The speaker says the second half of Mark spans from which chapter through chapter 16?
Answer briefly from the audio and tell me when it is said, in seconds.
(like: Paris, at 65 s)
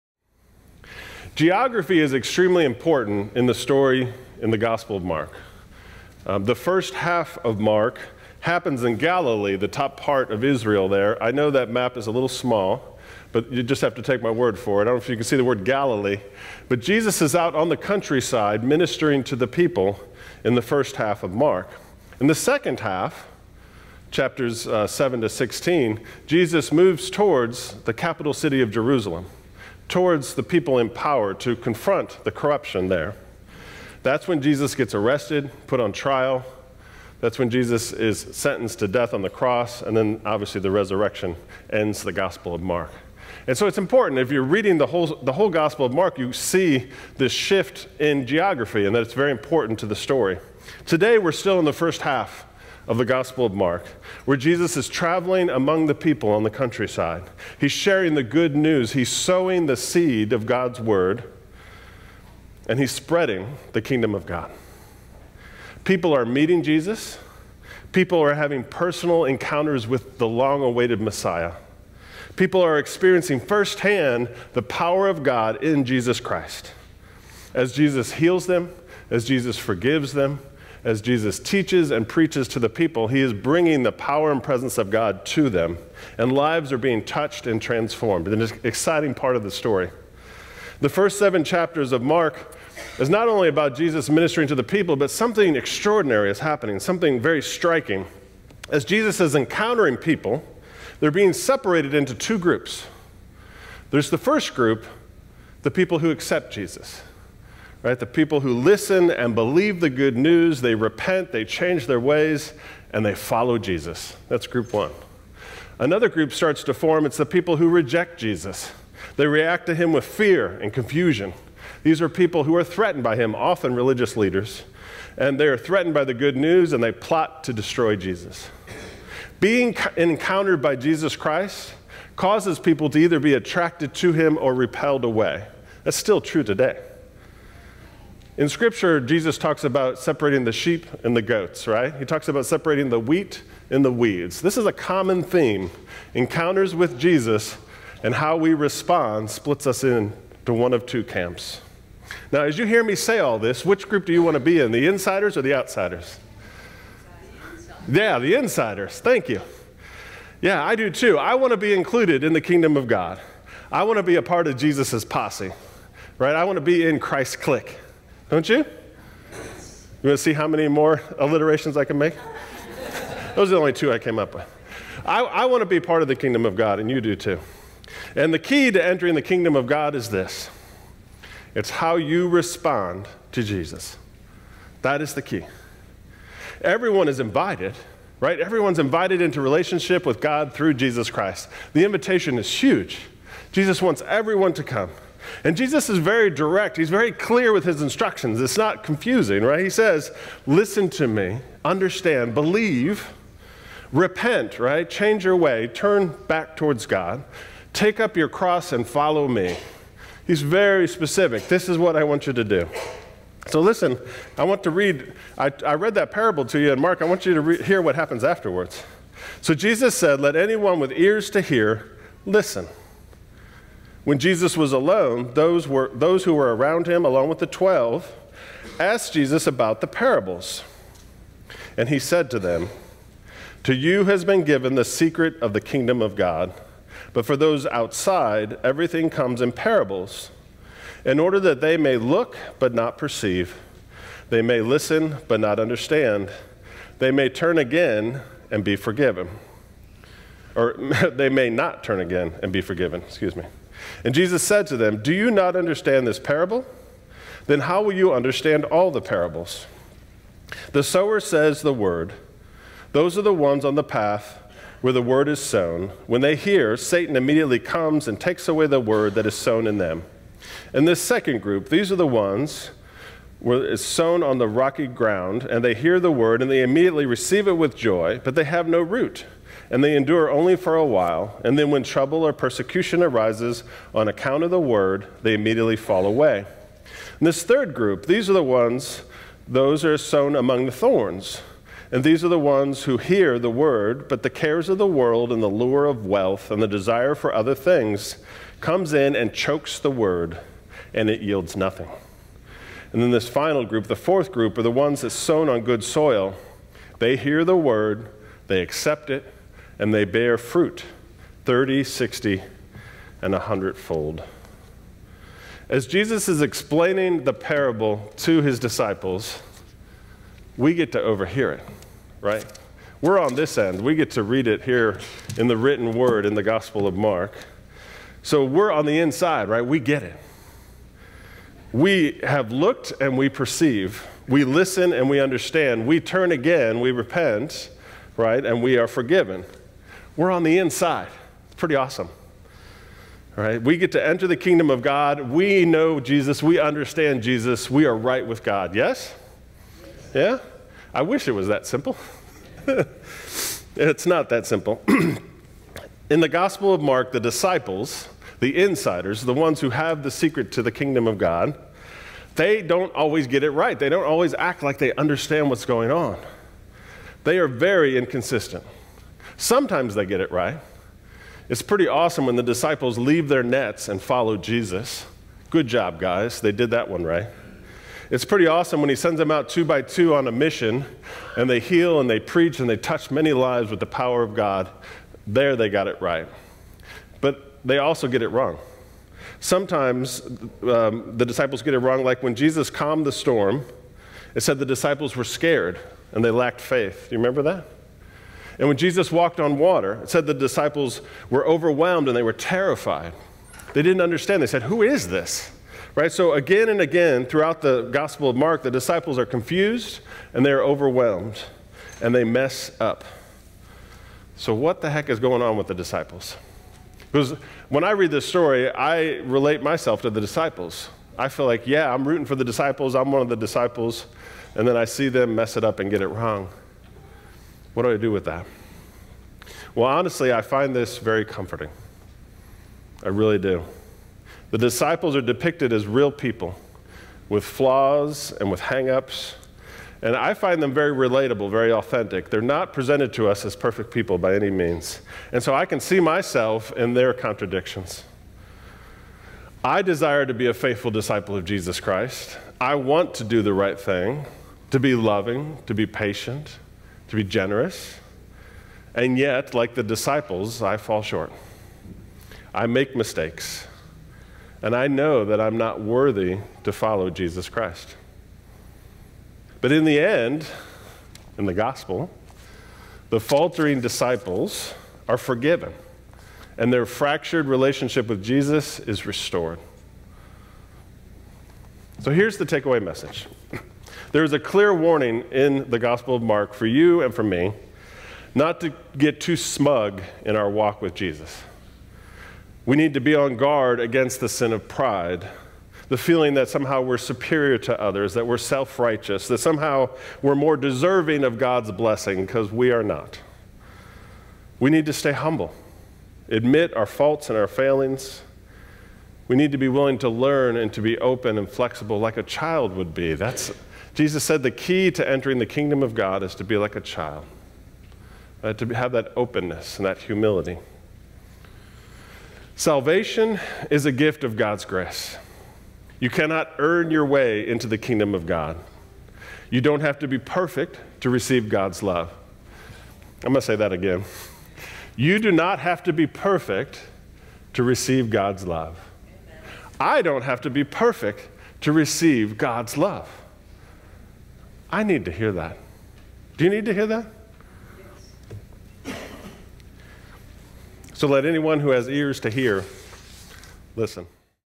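7, at 24 s.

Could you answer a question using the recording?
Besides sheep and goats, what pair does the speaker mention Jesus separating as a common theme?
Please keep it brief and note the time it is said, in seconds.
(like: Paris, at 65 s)
The wheat and the weeds, at 142 s.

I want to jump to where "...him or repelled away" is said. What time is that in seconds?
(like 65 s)
134 s.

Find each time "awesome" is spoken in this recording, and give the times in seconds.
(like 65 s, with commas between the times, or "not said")
341 s, 371 s, 378 s.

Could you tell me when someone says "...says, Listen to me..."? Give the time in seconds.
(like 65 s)
199 s.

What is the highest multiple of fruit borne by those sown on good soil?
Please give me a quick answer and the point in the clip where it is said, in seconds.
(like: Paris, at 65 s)
100 fold, at 313 s.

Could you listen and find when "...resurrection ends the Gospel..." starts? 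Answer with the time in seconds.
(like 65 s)
40 s.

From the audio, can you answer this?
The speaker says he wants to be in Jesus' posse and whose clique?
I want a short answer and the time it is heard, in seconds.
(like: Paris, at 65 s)
Christ's clique, at 166 s.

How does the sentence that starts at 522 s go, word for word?
Salvation is a gift of God's grace.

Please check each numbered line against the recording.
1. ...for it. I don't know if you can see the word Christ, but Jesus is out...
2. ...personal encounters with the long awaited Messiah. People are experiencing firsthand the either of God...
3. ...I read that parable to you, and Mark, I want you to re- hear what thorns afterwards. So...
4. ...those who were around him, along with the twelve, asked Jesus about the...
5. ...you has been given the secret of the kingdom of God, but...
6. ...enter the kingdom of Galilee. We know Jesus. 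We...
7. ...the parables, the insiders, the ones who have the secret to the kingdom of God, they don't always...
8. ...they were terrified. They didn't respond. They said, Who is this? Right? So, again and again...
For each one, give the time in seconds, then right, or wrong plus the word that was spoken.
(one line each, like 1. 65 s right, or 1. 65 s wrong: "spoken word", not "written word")
1. 14 s wrong: "Galilee", not "Christ"
2. 68 s wrong: "power", not "either"
3. 215 s wrong: "happens", not "thorns"
4. 225 s right
5. 233 s right
6. 344 s wrong: "God", not "Galilee"
7. 357 s wrong: "disciples", not "parables"
8. 402 s wrong: "understand", not "respond".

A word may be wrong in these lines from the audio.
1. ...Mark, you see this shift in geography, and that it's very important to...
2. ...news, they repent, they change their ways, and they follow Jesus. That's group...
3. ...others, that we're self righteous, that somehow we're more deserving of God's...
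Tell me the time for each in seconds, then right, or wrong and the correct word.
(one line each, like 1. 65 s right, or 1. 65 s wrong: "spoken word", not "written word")
1. 45 s right
2. 110 s right
3. 497 s right.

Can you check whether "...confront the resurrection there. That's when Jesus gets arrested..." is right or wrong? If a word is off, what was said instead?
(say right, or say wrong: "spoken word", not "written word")
wrong: "corruption", not "resurrection".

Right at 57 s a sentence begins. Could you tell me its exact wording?
He's sharing the good news, he's sowing the seed of God's word, and he's spreading the kingdom of God.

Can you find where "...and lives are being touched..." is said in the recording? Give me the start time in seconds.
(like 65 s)
86 s.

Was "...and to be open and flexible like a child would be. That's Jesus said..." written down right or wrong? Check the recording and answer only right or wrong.
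right.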